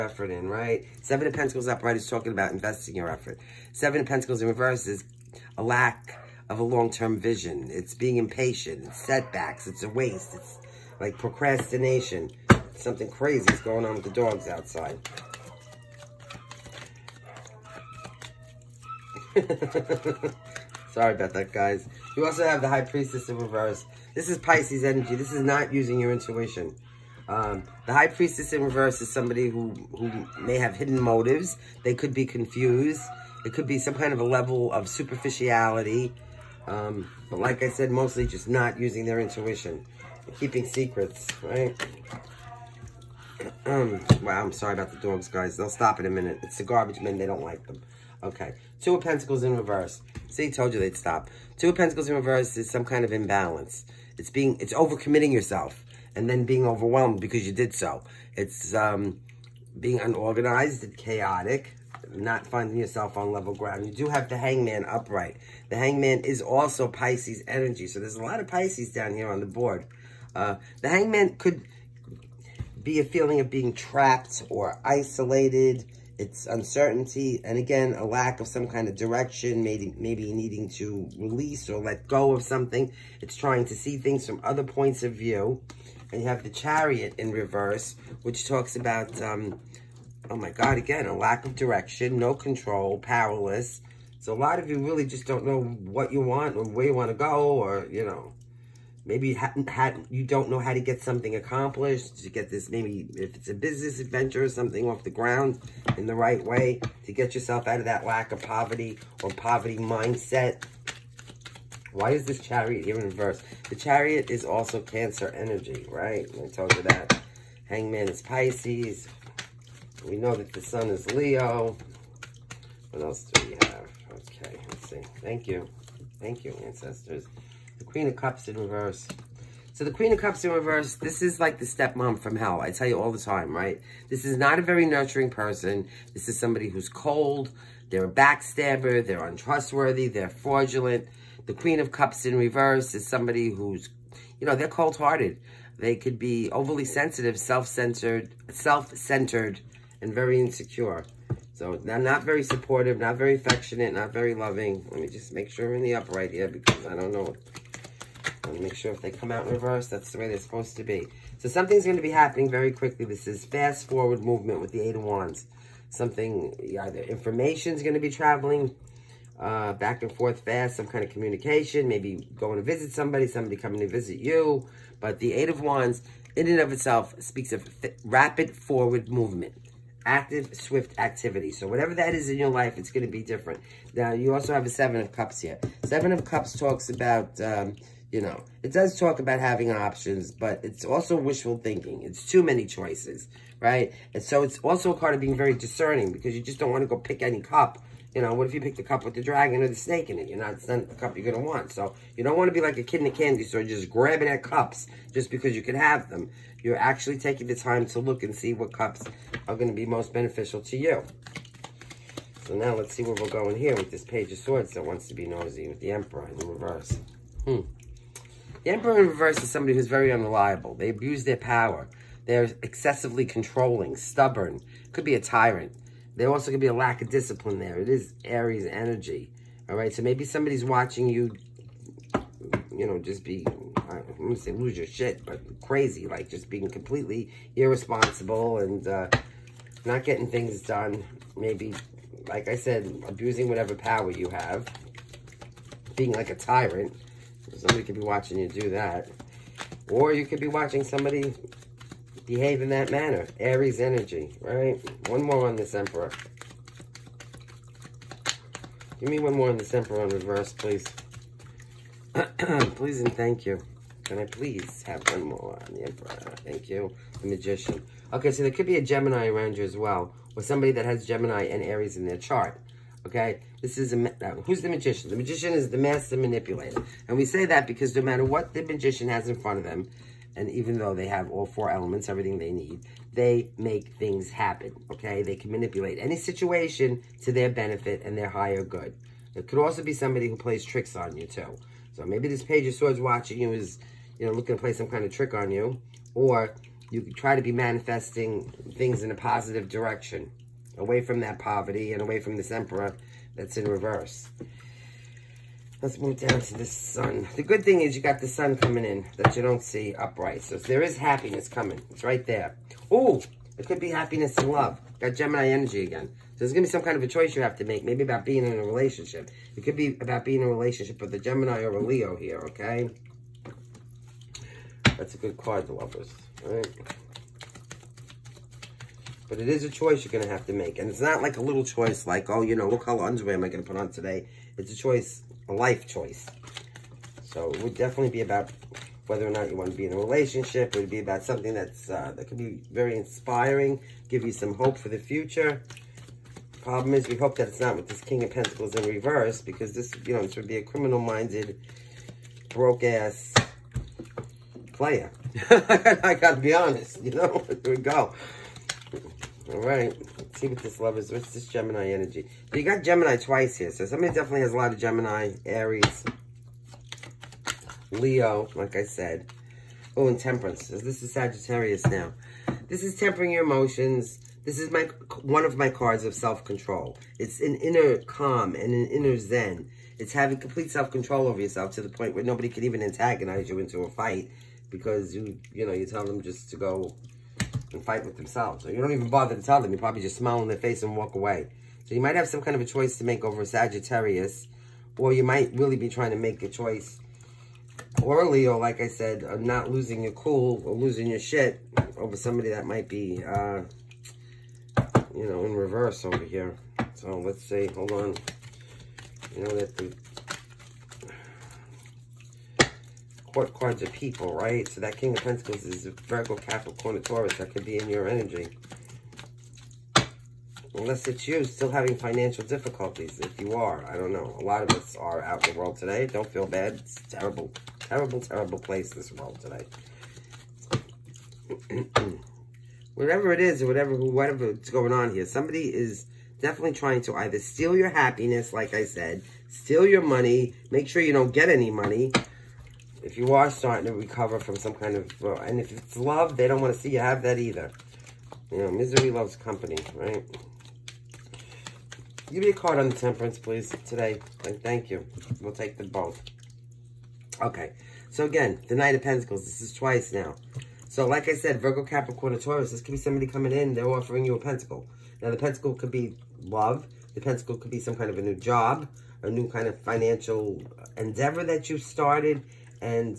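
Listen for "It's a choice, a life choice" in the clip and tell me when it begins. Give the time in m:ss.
5:34.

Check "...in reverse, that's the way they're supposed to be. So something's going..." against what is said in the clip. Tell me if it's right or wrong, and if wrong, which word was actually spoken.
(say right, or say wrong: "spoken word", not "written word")
right.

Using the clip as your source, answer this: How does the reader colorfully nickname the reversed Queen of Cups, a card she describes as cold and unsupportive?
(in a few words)
The stepmom from hell.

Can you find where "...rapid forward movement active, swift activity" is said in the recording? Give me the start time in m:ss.
2:58.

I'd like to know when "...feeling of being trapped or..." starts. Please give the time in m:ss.
1:13.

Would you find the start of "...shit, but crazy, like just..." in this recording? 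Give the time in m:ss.
3:54.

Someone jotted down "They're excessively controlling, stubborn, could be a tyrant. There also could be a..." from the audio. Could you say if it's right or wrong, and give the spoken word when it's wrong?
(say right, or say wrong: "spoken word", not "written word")
right.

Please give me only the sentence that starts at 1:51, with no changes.
Why is this chariot here in reverse?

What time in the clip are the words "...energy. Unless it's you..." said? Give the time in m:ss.
6:58.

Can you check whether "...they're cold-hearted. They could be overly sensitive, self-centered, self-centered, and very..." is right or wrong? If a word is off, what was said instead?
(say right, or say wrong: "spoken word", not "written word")
right.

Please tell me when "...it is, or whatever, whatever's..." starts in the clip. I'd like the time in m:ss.
7:13.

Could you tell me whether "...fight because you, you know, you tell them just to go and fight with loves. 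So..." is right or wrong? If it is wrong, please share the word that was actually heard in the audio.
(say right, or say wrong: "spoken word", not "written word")
wrong: "themselves", not "loves".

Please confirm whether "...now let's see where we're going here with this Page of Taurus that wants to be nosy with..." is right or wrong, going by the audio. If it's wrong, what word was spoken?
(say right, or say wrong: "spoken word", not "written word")
wrong: "Swords", not "Taurus".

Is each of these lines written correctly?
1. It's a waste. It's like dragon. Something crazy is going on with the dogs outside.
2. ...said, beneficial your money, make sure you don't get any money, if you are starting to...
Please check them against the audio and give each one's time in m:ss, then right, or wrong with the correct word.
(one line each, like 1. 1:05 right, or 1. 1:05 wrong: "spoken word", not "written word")
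1. 0:09 wrong: "procrastination", not "dragon"
2. 7:18 wrong: "steal", not "beneficial".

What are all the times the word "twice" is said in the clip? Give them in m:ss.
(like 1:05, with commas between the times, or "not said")
6:03, 7:39.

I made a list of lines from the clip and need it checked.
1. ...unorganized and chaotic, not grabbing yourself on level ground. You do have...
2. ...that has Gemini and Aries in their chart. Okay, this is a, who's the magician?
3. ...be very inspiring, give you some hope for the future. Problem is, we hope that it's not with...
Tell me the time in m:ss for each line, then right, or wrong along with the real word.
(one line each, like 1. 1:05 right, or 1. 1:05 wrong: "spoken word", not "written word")
1. 1:00 wrong: "finding", not "grabbing"
2. 4:30 right
3. 5:42 right.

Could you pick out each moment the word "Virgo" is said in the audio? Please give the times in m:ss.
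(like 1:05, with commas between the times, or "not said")
6:55, 7:41.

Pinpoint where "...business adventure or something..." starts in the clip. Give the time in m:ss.
1:43.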